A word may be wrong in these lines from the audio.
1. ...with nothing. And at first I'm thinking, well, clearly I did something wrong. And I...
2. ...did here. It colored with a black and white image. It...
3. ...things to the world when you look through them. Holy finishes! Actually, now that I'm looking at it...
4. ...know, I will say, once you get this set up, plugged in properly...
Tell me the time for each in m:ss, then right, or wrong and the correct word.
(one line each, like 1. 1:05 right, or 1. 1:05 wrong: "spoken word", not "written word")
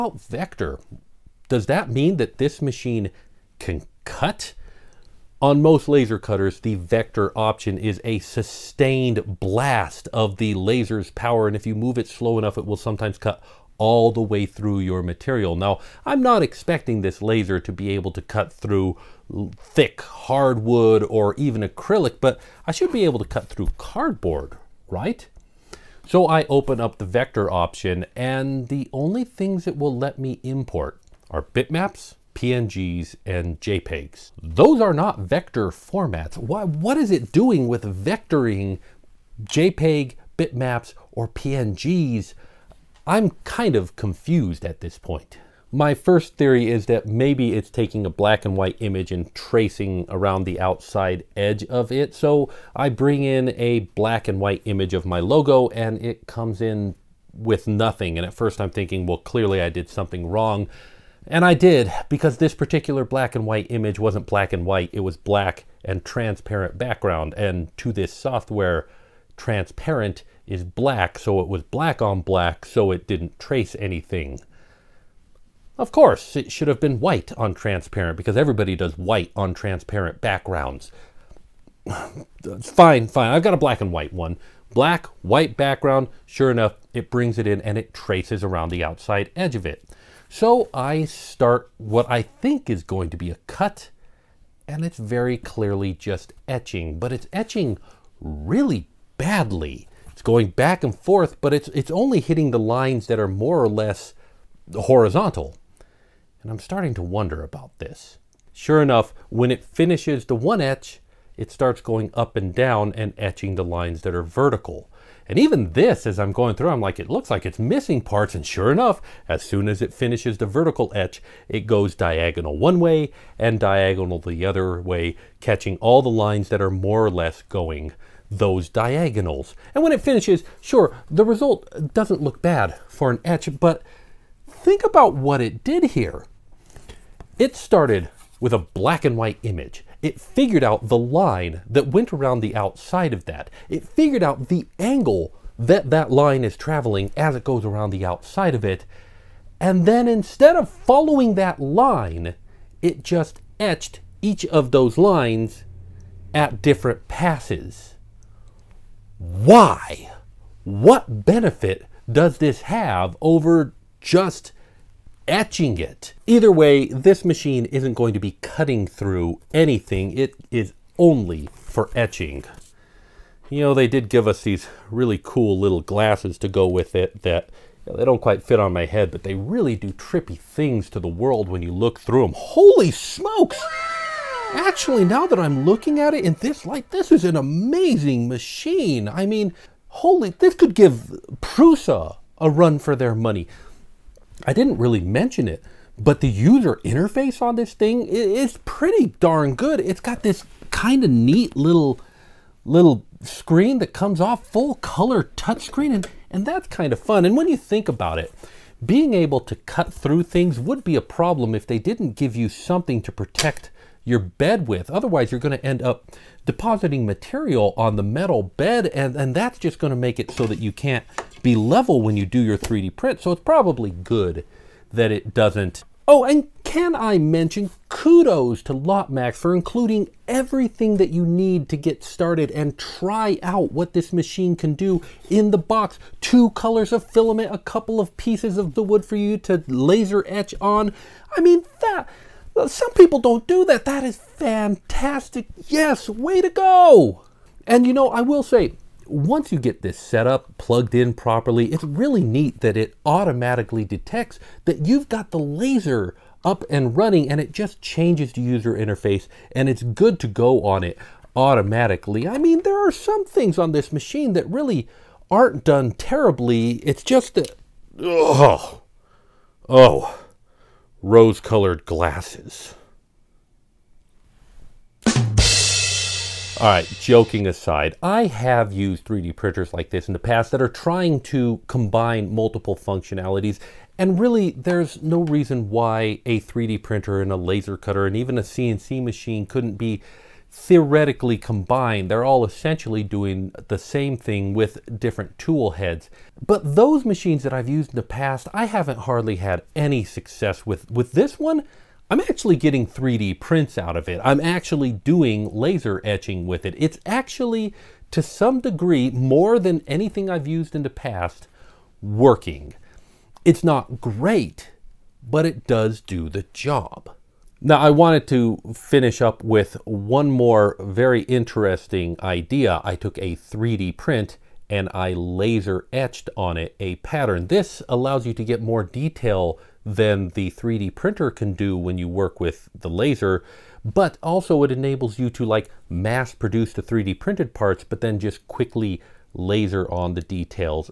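1. 0:57 right
2. 2:15 wrong: "started", not "colored"
3. 3:00 wrong: "smokes", not "finishes"
4. 4:07 right.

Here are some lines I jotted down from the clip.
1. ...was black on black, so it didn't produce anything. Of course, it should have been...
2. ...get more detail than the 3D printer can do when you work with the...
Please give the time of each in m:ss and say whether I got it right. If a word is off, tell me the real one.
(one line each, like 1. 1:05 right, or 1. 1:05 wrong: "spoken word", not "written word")
1. 1:11 wrong: "trace", not "produce"
2. 5:28 right.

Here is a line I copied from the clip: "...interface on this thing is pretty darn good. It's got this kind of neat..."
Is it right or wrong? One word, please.
right.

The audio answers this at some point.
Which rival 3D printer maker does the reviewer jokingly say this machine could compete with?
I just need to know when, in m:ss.
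3:11.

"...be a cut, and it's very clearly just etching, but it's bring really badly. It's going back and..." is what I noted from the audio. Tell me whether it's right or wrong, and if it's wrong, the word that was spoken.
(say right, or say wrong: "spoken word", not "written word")
wrong: "etching", not "bring".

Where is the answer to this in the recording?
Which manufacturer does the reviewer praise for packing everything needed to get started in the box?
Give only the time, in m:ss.
3:48.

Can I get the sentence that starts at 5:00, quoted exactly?
With this one, I'm actually getting 3D prints out of it.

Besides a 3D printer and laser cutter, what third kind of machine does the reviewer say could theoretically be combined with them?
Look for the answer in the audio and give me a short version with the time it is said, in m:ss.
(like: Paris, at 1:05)
CNC machine, at 4:48.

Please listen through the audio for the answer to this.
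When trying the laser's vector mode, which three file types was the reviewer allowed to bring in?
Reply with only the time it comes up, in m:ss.
0:31.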